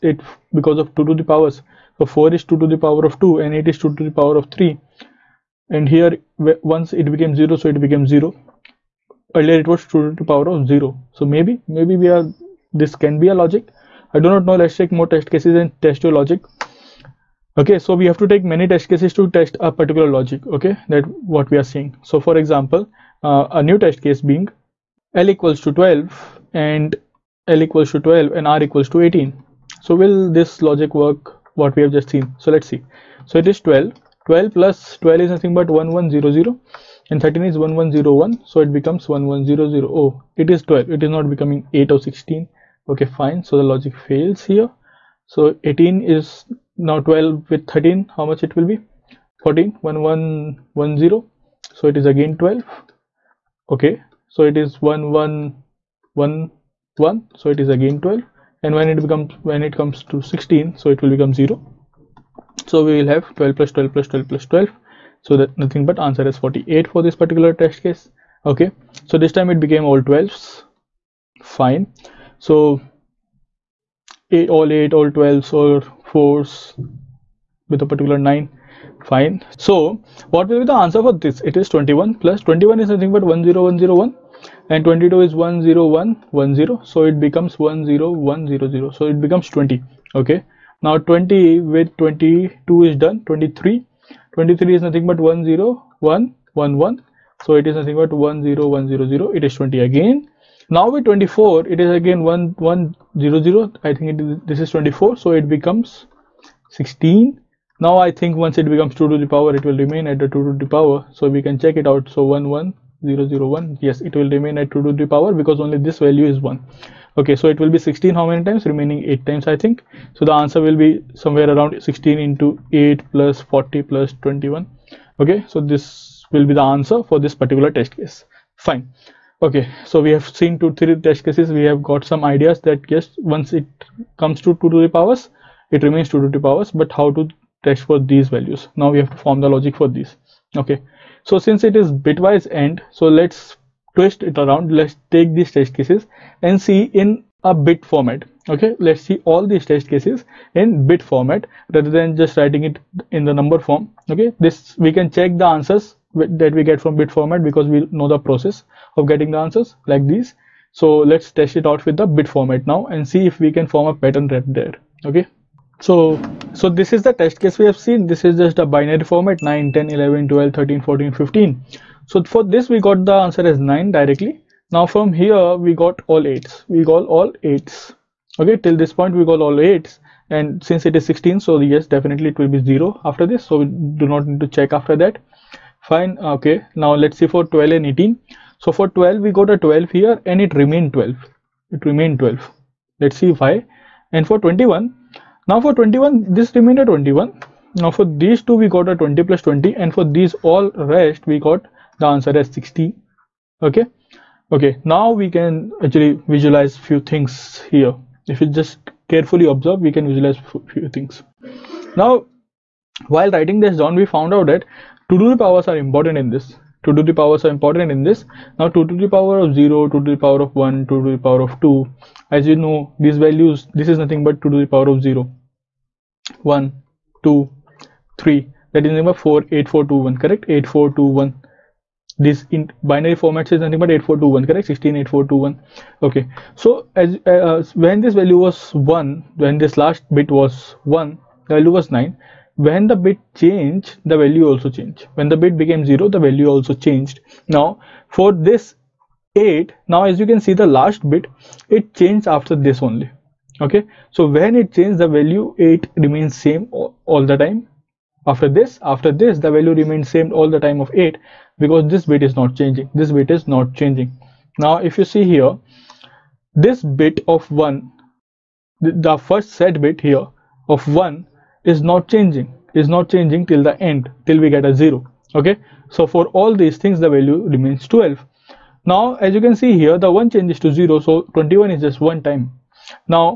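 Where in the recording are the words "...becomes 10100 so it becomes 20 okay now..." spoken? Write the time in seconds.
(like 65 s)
87 s.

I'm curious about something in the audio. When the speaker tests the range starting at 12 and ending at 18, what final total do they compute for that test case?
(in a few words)
48.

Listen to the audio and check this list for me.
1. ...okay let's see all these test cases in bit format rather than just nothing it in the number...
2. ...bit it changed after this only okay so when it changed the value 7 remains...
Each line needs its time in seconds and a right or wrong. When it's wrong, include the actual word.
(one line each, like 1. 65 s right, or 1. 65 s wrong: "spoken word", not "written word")
1. 148 s wrong: "writing", not "nothing"
2. 251 s wrong: "8", not "7".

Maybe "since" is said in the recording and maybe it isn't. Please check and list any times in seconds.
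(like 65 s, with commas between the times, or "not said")
141 s, 180 s.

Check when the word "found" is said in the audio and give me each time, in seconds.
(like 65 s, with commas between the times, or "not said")
214 s.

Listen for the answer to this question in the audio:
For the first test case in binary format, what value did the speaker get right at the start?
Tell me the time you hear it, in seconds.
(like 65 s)
173 s.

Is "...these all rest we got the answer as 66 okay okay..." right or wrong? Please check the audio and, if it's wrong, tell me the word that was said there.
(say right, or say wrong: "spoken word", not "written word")
wrong: "60", not "66".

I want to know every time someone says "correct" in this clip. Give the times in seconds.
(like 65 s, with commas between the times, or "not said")
230 s, 234 s.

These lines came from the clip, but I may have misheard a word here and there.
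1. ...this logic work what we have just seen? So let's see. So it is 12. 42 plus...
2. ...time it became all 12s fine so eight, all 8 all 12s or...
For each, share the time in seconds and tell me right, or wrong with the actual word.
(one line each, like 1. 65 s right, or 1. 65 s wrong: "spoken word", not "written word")
1. 30 s wrong: "12", not "42"
2. 69 s right.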